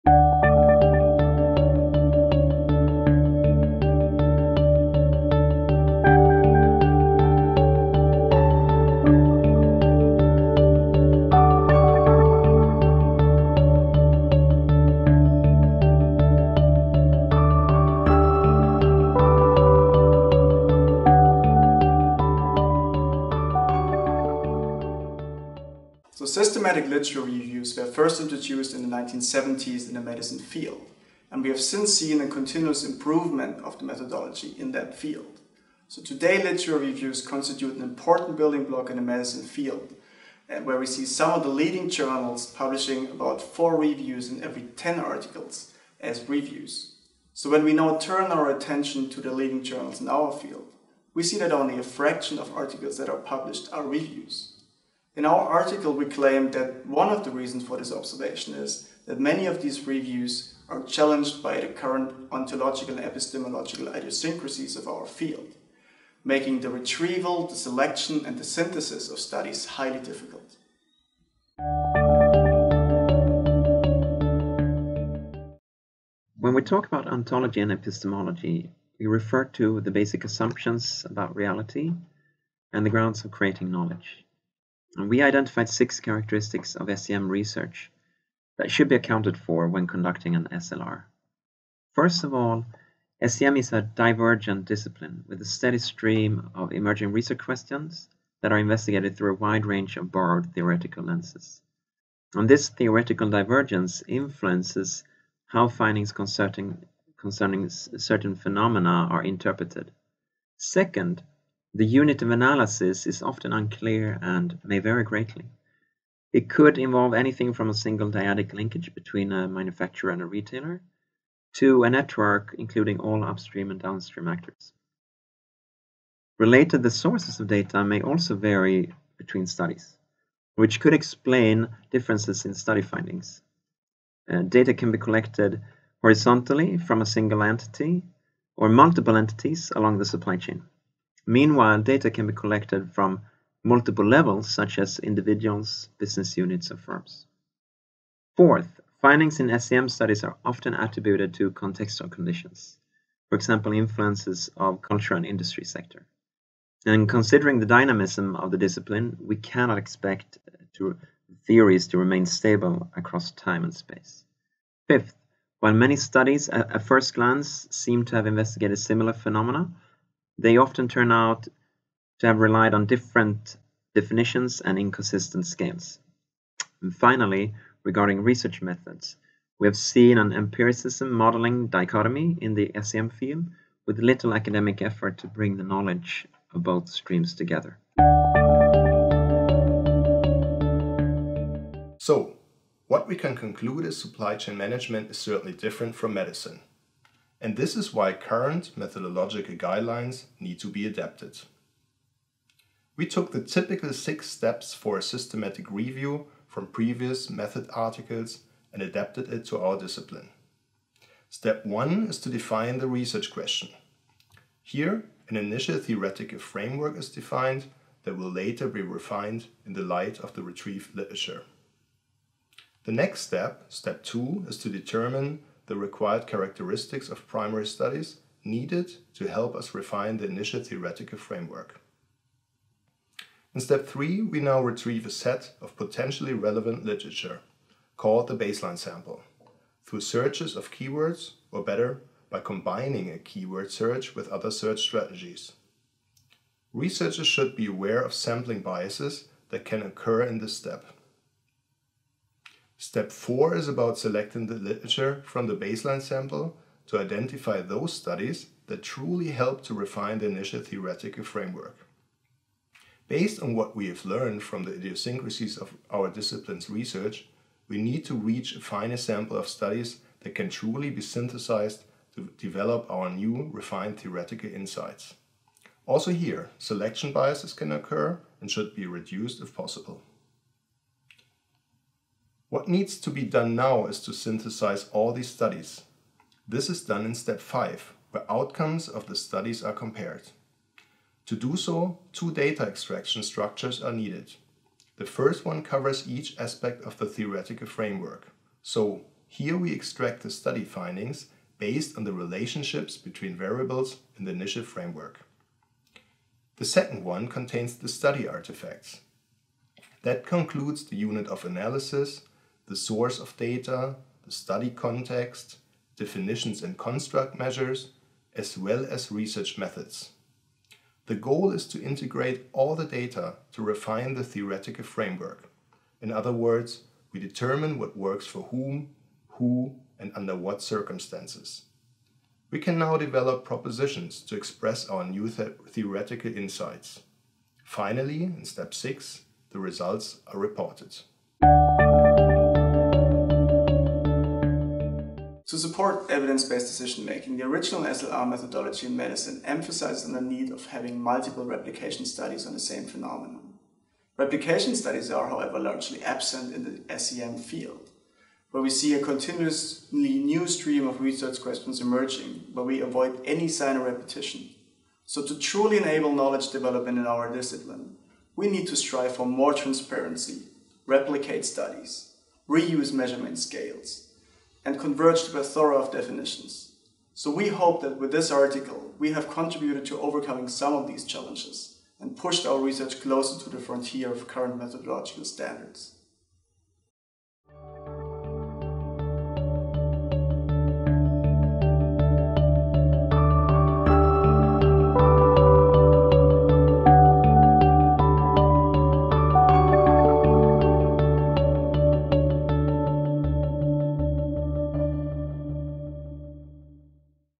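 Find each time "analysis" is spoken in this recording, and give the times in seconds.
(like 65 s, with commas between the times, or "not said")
112 s, 311 s.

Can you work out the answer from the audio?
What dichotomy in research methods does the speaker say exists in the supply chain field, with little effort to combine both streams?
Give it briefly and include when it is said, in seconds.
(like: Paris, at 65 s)
empiricism modeling dichotomy, at 180 s.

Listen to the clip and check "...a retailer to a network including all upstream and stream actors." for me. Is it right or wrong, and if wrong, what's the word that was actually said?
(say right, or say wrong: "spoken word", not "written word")
wrong: "downstream", not "stream".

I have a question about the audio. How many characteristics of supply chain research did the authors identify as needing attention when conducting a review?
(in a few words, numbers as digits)
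6.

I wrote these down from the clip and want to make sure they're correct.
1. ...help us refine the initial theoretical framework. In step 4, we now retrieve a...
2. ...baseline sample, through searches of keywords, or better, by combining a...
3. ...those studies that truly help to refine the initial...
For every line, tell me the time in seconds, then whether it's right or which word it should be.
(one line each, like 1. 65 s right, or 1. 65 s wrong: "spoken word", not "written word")
1. 229 s wrong: "3", not "4"
2. 238 s right
3. 257 s right.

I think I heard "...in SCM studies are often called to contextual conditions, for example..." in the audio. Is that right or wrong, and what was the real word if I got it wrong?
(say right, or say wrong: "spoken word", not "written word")
wrong: "attributed", not "called".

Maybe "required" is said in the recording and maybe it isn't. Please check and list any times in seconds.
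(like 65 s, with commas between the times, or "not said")
225 s.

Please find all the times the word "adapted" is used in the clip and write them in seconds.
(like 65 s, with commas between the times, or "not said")
200 s, 208 s.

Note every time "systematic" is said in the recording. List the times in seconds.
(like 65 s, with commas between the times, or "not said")
26 s, 205 s.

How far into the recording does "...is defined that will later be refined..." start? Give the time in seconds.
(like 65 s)
216 s.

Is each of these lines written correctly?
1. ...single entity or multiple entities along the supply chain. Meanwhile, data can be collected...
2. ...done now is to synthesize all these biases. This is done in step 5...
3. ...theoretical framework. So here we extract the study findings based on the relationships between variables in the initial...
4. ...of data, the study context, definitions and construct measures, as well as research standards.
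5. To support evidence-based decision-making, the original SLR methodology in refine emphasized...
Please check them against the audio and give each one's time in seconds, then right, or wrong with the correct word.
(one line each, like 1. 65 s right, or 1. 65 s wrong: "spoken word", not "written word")
1. 137 s right
2. 283 s wrong: "studies", not "biases"
3. 297 s right
4. 313 s wrong: "methods", not "standards"
5. 345 s wrong: "medicine", not "refine".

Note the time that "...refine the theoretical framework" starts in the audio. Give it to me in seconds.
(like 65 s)
323 s.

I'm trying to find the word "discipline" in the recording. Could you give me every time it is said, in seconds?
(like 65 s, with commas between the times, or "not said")
94 s, 158 s, 209 s, 266 s, 367 s.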